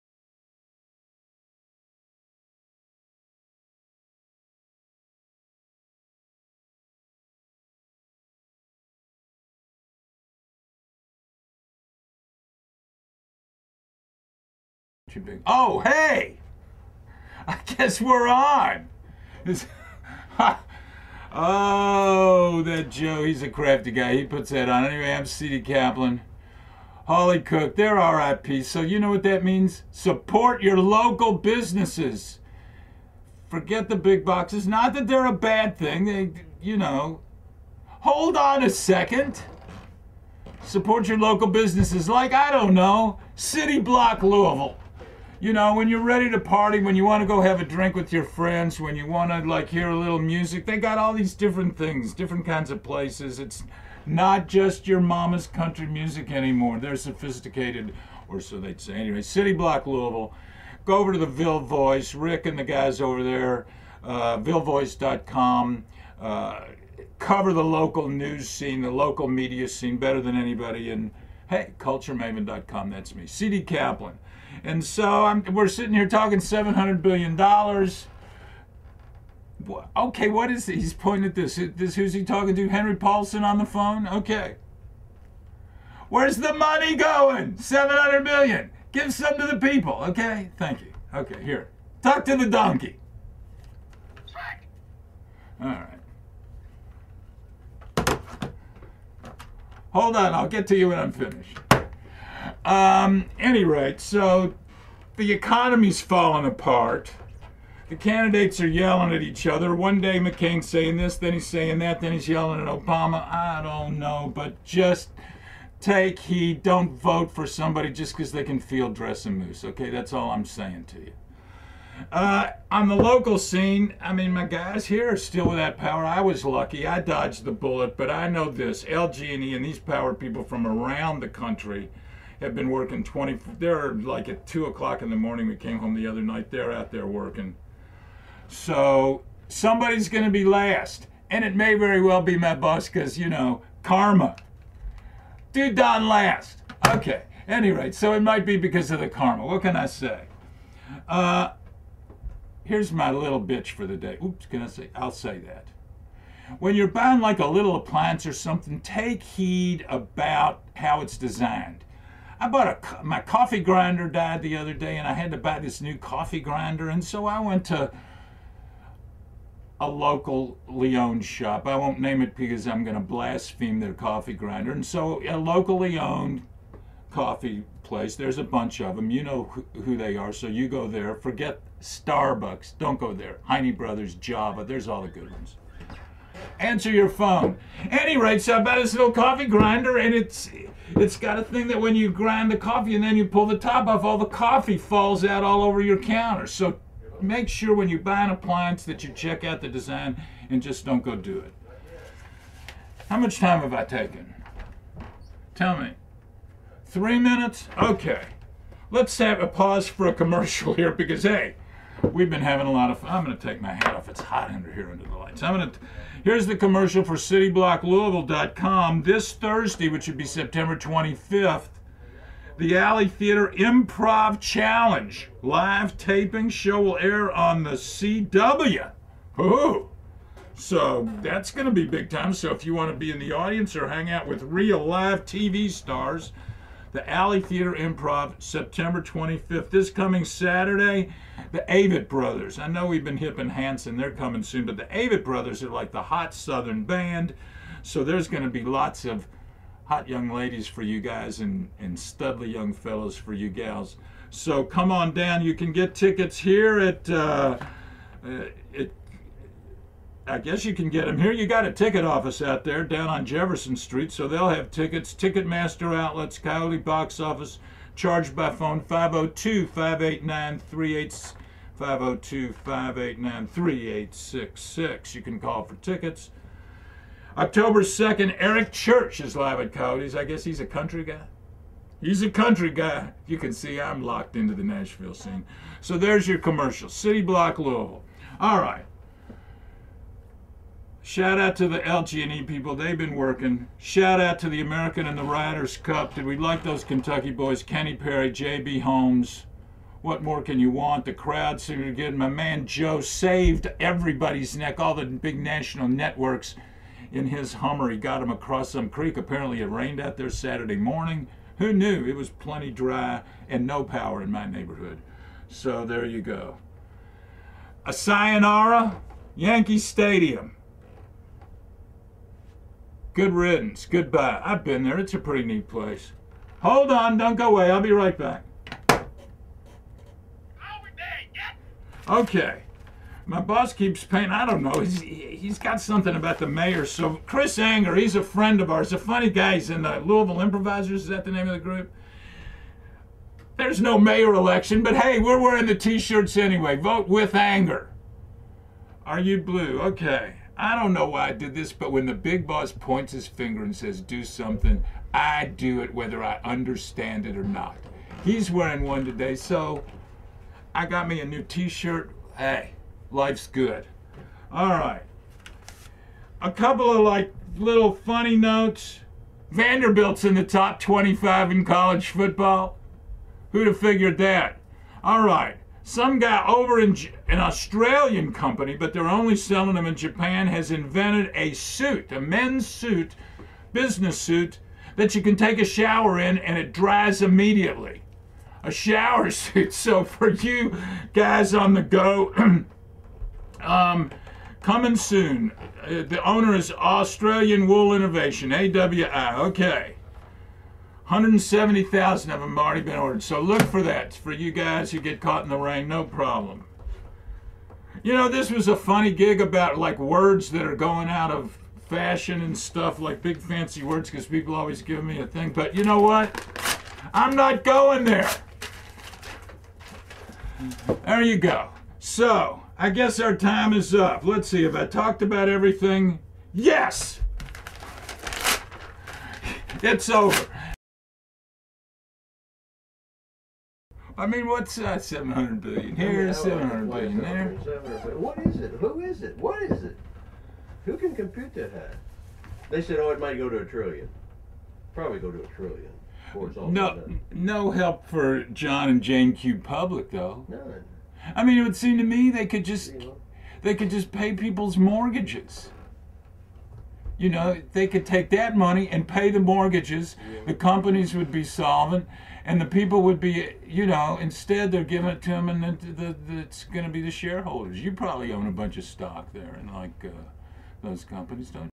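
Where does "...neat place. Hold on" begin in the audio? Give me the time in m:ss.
5:25.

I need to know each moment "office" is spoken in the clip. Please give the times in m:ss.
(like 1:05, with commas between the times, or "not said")
4:22, 4:27.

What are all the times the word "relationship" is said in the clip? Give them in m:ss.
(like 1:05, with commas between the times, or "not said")
not said.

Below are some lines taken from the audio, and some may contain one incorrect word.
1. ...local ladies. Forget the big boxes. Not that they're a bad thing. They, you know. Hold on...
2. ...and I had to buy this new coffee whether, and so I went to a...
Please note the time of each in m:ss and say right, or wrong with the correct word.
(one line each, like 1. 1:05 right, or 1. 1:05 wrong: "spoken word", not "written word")
1. 0:30 wrong: "businesses", not "ladies"
2. 2:44 wrong: "grinder", not "whether".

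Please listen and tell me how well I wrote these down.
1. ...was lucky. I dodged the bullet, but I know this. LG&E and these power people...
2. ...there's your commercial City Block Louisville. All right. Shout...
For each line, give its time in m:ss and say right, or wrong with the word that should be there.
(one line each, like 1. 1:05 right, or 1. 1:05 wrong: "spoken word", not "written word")
1. 2:06 right
2. 4:45 right.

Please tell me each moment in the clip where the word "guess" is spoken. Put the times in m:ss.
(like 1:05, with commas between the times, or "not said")
0:17, 4:20, 4:40, 7:02.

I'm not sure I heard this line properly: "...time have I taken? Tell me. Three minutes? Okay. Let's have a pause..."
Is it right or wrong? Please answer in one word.
right.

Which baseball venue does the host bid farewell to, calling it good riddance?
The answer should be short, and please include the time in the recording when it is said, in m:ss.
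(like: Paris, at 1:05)
Yankee Stadium, at 5:19.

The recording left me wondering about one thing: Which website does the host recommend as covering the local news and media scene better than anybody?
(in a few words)
villevoice.com.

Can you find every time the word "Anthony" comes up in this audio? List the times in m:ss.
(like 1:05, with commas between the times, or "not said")
not said.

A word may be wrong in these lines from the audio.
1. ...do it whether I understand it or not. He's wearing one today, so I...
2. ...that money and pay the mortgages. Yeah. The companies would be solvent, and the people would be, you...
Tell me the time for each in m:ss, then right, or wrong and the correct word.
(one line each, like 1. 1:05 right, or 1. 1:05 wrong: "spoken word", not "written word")
1. 5:55 right
2. 7:38 right.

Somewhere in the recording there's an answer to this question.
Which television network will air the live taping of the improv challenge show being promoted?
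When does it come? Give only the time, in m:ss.
3:47.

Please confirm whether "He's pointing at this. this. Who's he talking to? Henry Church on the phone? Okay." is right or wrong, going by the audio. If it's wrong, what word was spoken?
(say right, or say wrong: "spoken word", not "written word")
wrong: "Paulson", not "Church".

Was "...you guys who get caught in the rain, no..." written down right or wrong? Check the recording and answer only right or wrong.
right.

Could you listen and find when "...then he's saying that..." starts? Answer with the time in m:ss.
1:51.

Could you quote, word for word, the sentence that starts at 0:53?
It's not just your mama's country music anymore.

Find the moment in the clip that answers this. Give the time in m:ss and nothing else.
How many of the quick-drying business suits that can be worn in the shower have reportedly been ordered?
6:41.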